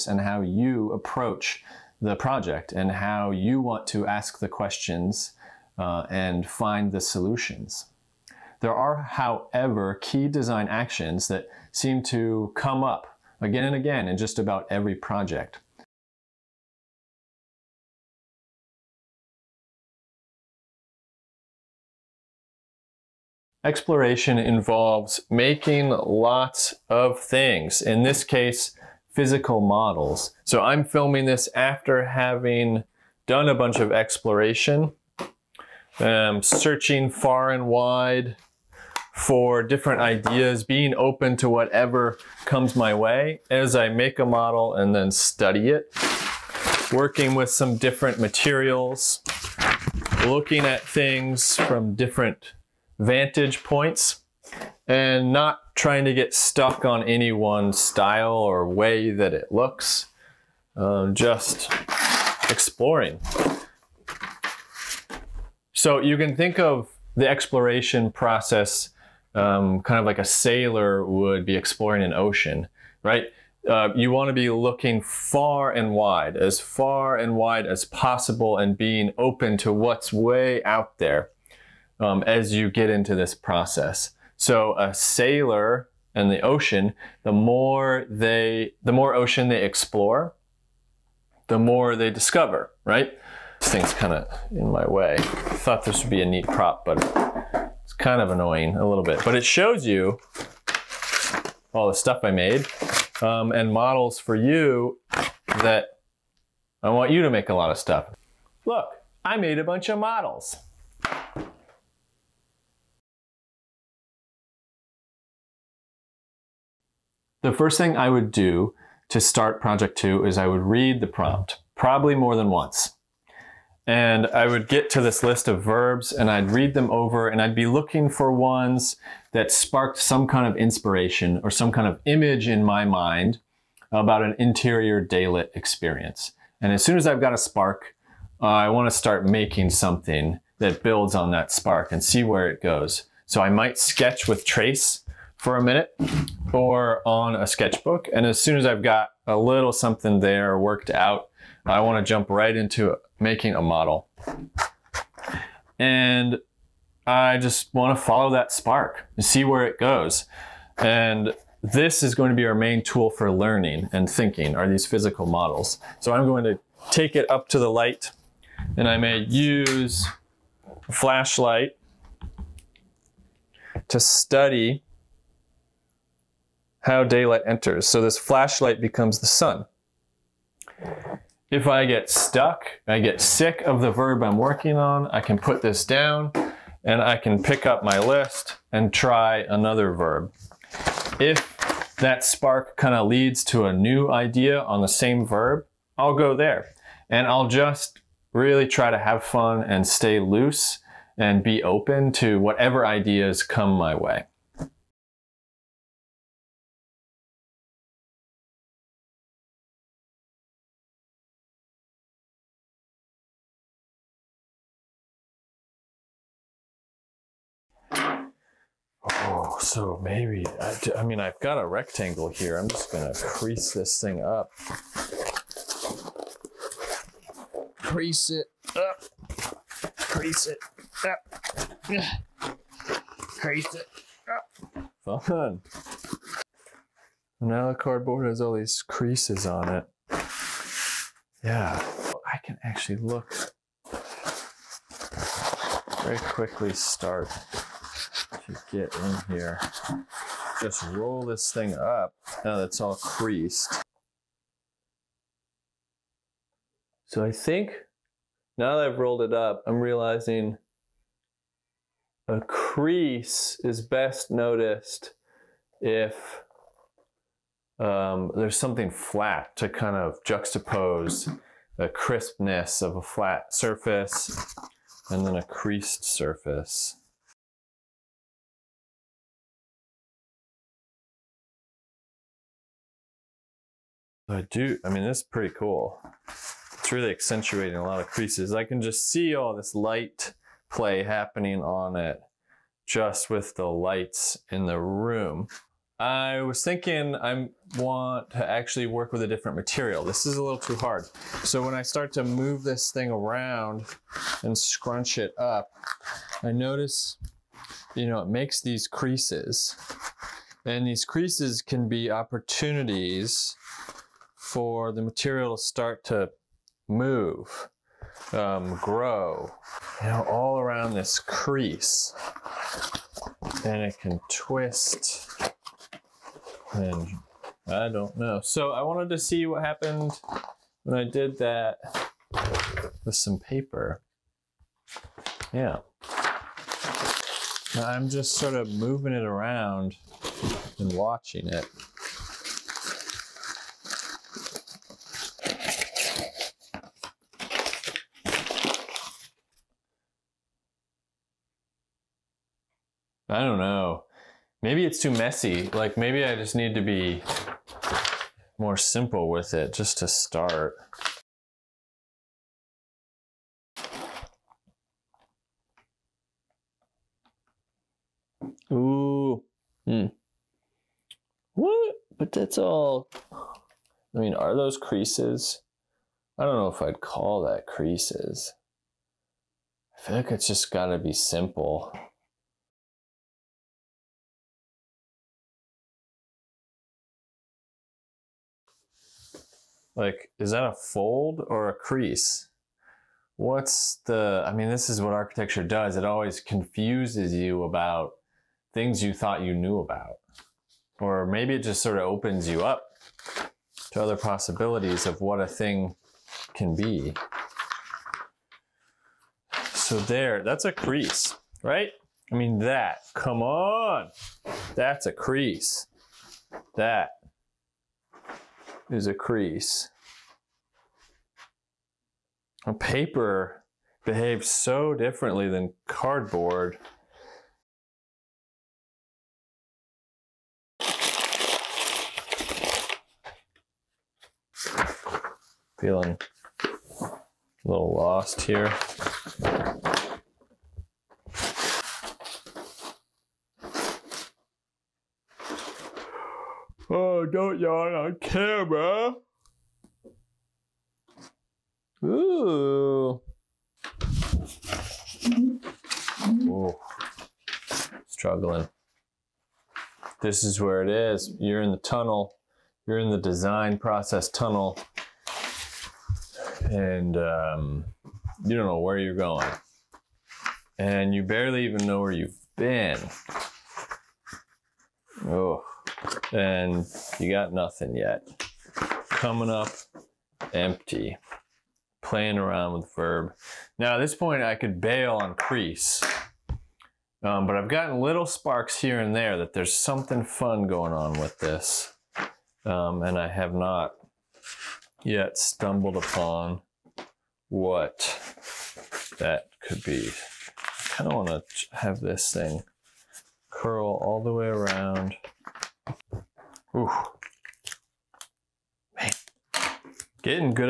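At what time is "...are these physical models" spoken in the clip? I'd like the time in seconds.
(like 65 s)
164 s.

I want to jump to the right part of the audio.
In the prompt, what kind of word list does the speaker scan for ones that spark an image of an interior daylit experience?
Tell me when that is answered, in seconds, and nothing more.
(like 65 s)
125 s.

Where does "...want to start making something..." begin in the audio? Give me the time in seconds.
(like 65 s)
138 s.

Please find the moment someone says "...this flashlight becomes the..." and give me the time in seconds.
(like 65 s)
178 s.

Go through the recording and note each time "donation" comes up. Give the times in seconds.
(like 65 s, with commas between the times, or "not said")
not said.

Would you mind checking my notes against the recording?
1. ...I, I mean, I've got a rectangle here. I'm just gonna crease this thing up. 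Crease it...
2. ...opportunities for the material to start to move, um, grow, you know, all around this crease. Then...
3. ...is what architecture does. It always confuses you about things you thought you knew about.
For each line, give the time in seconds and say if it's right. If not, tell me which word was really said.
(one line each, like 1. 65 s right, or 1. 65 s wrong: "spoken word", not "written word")
1. 220 s right
2. 312 s right
3. 394 s right.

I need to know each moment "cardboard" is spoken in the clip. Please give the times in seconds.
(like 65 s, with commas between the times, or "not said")
237 s, 425 s.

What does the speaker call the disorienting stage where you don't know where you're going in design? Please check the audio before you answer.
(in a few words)
The design process tunnel.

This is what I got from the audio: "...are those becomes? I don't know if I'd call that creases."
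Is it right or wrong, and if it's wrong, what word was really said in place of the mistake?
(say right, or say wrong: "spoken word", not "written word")
wrong: "creases", not "becomes".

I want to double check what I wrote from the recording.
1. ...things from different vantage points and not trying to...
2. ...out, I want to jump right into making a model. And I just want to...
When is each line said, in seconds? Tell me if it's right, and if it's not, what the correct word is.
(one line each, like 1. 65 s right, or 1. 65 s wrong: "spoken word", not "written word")
1. 50 s right
2. 150 s right.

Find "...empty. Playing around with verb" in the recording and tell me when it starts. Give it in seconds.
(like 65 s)
480 s.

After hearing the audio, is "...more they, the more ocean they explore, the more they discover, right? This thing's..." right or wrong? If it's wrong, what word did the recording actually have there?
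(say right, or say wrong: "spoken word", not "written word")
right.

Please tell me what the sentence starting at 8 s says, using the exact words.
There are, however, key design actions that seem to come up again and again in just about every project.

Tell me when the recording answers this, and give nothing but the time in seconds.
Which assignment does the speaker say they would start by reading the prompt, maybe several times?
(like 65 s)
119 s.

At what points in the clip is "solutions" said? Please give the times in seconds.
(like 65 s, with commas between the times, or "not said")
6 s.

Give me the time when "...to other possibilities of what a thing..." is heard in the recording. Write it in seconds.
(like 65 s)
403 s.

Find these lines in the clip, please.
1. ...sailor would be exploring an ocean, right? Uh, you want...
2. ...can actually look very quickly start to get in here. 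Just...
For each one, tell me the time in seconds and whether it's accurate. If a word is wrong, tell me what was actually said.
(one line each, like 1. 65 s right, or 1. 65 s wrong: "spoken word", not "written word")
1. 70 s right
2. 242 s right.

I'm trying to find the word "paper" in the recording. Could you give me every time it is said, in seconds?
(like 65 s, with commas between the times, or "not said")
333 s, 422 s.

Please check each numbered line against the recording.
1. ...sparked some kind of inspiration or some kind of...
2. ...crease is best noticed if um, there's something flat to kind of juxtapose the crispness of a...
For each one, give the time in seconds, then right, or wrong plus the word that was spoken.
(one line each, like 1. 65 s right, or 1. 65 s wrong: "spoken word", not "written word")
1. 129 s right
2. 262 s right.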